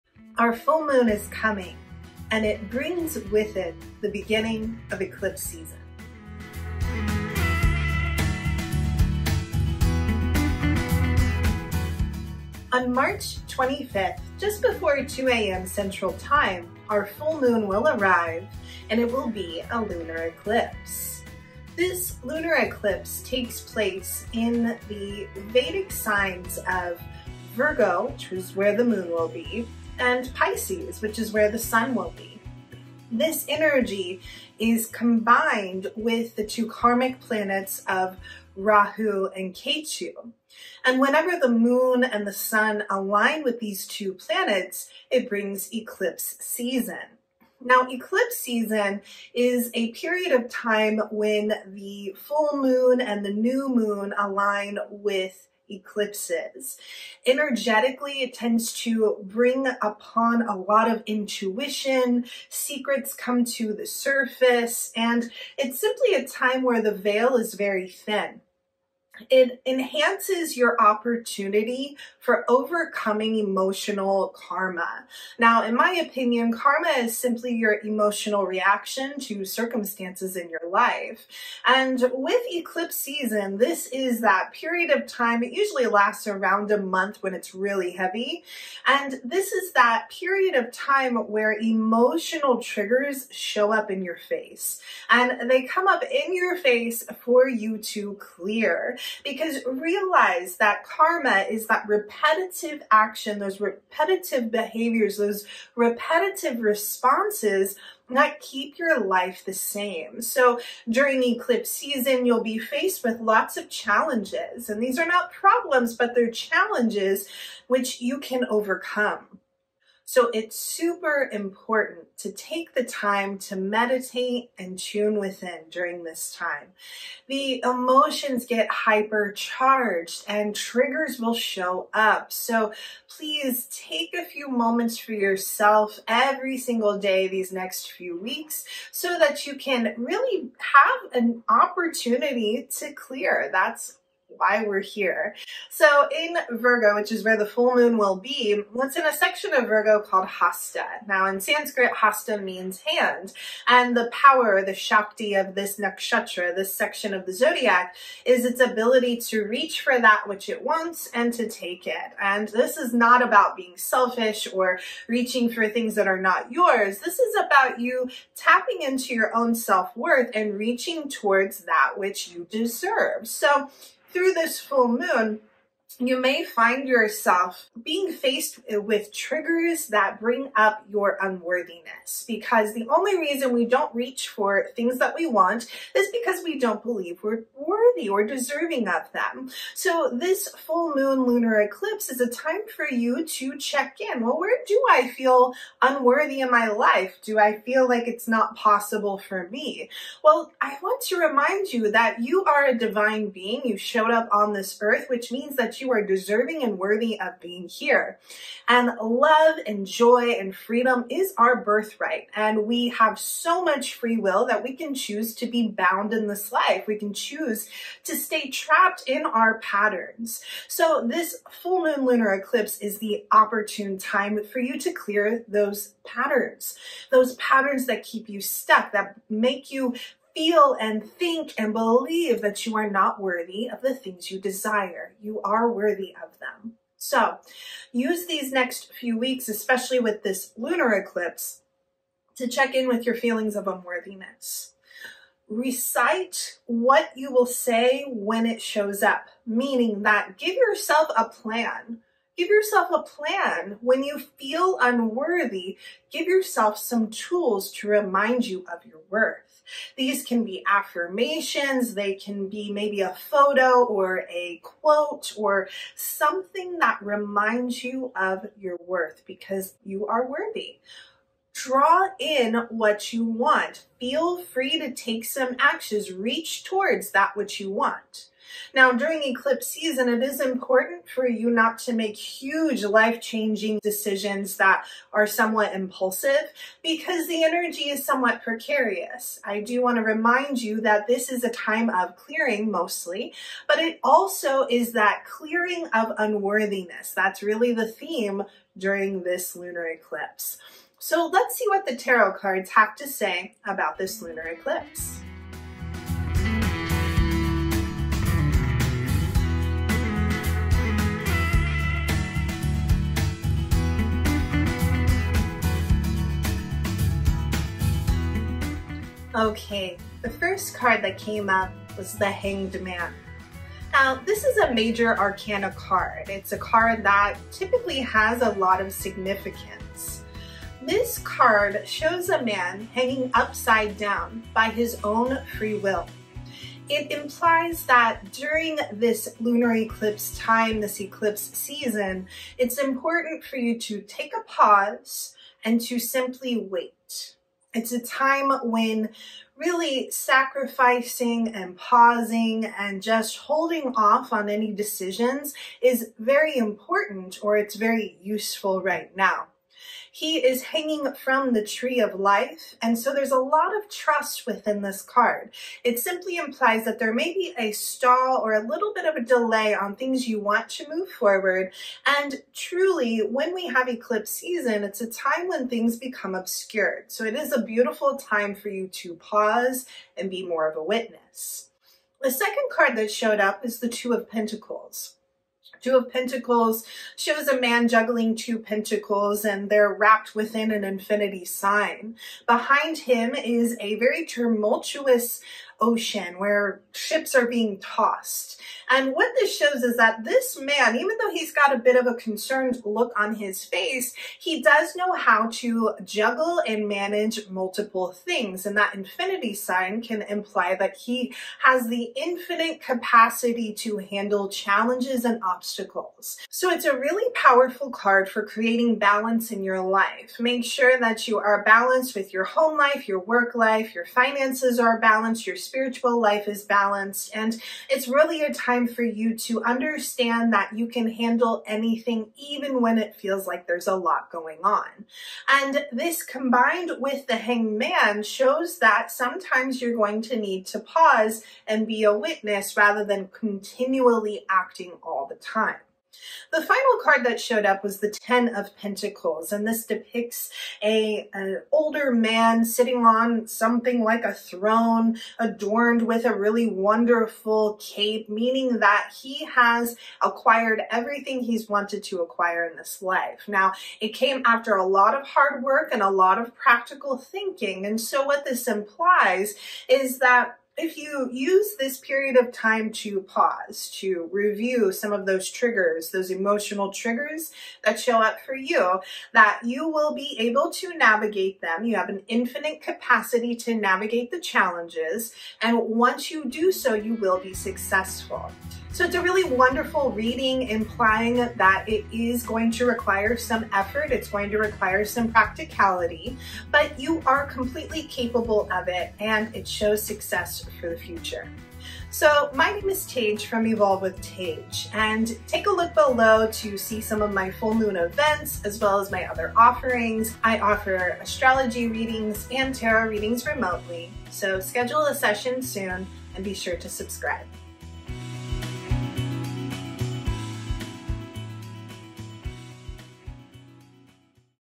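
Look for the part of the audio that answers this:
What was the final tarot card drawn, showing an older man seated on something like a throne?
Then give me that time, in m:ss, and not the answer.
7:28.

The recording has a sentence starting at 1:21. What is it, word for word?
And with eclipse season, this is that period of time.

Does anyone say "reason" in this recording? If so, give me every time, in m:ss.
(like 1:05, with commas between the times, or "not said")
3:03.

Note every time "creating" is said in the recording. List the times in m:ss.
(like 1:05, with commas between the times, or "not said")
6:58.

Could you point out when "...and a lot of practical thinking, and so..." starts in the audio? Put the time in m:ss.
7:45.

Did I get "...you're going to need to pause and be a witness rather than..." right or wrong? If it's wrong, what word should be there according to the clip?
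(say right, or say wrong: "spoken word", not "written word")
right.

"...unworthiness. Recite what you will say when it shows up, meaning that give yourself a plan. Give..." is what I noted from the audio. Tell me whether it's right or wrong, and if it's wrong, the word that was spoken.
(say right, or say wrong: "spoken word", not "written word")
right.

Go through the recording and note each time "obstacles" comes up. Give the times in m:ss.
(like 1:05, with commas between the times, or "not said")
6:55.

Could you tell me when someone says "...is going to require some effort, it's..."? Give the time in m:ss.
8:12.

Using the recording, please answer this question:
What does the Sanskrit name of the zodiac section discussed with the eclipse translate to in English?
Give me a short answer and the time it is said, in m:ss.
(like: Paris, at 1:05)
hand, at 2:32.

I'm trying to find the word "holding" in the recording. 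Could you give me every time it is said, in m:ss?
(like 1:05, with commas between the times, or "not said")
5:53.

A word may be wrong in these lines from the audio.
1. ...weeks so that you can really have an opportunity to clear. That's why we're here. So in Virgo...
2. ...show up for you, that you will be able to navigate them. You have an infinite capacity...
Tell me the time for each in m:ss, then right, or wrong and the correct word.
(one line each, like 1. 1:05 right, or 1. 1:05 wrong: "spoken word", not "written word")
1. 2:18 right
2. 7:57 right.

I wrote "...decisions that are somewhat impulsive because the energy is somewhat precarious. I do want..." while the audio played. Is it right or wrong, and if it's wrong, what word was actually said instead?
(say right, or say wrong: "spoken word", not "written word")
right.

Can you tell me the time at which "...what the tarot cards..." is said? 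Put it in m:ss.
5:01.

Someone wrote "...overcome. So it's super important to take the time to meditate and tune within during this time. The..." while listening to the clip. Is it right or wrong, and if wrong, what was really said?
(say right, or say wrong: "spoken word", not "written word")
right.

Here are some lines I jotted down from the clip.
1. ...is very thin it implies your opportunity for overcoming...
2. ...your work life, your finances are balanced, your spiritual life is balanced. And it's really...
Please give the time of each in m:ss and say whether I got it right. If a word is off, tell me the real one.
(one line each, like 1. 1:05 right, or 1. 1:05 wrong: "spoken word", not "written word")
1. 1:07 wrong: "enhances", not "implies"
2. 7:03 right.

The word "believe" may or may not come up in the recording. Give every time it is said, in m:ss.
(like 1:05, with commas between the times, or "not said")
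3:06, 3:51.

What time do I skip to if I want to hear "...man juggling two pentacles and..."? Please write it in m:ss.
6:27.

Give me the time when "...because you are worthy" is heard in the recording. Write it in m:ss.
4:29.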